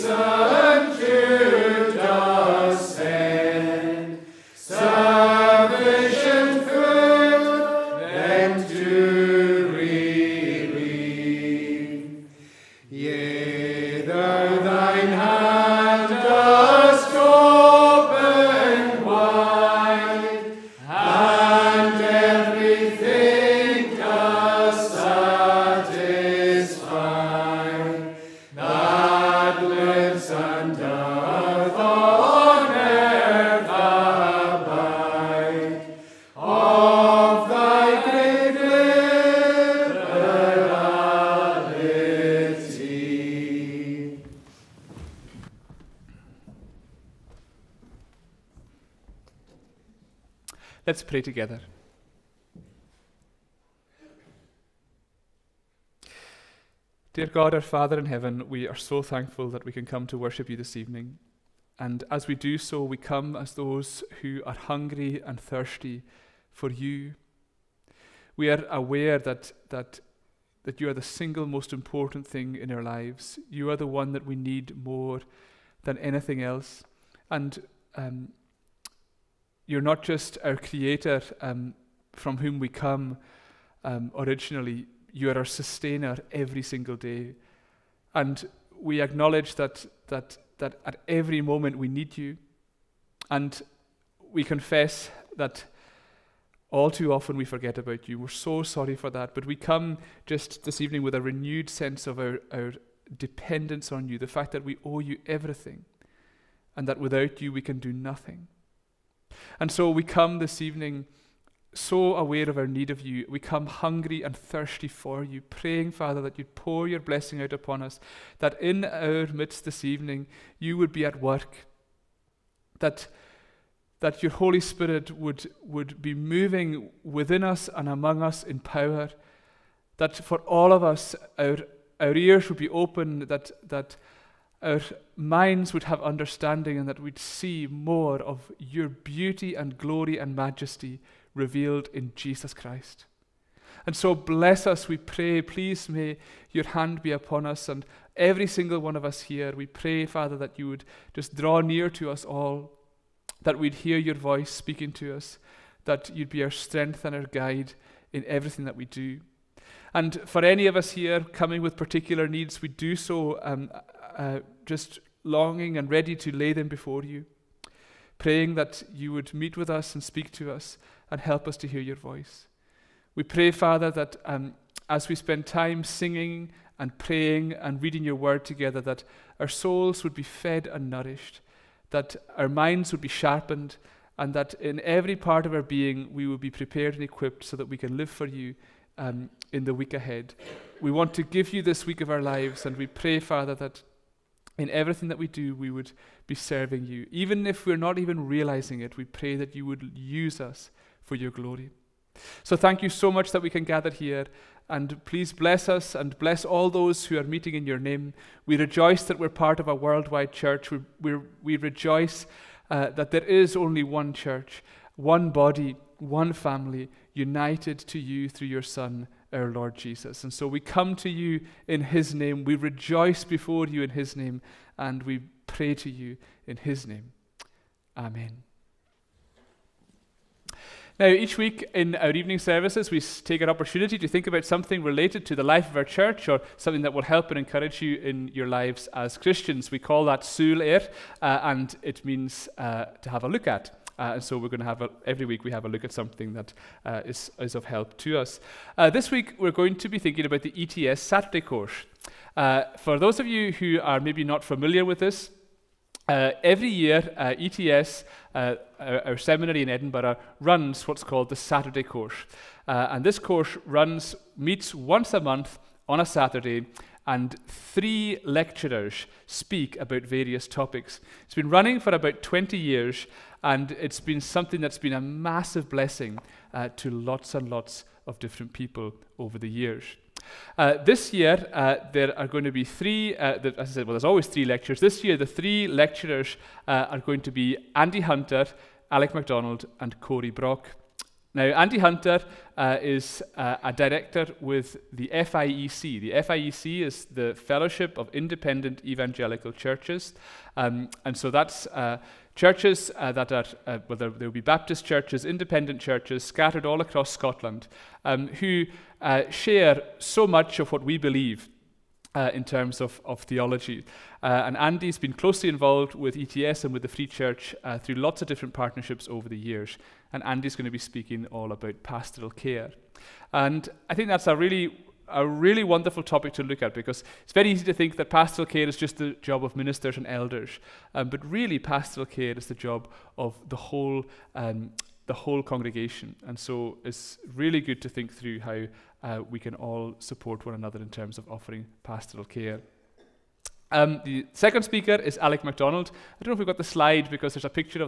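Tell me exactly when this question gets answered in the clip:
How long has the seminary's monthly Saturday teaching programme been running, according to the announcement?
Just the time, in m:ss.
4:31.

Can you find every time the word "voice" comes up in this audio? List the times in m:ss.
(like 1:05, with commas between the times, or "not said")
2:34, 2:51.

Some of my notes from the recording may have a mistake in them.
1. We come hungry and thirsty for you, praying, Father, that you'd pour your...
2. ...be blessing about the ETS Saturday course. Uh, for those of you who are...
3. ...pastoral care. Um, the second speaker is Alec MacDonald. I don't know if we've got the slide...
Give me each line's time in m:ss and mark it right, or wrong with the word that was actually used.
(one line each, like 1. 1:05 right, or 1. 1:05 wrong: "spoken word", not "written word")
1. 1:53 right
2. 4:09 wrong: "thinking", not "blessing"
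3. 5:41 right.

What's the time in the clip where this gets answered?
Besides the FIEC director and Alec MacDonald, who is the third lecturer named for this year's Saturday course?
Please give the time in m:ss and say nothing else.
4:49.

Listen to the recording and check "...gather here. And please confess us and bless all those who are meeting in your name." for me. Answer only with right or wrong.
wrong.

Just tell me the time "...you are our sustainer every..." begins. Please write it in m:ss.
1:25.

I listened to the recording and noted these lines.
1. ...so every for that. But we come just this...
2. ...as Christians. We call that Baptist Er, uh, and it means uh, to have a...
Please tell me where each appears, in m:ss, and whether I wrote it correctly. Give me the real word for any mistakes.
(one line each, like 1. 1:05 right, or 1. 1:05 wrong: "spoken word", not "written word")
1. 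1:38 wrong: "sorry", not "every"
2. 3:58 wrong: "Sul", not "Baptist".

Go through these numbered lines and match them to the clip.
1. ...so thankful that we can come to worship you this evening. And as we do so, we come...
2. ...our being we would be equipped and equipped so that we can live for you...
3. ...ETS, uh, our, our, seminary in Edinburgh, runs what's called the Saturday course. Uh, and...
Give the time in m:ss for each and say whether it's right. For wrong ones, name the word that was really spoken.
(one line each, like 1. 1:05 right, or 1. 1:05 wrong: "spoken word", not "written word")
1. 0:58 right
2. 3:05 wrong: "prepared", not "equipped"
3. 4:17 right.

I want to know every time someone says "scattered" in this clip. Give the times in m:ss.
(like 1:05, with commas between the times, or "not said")
5:06.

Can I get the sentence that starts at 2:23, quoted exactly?
And so bless us, we pray.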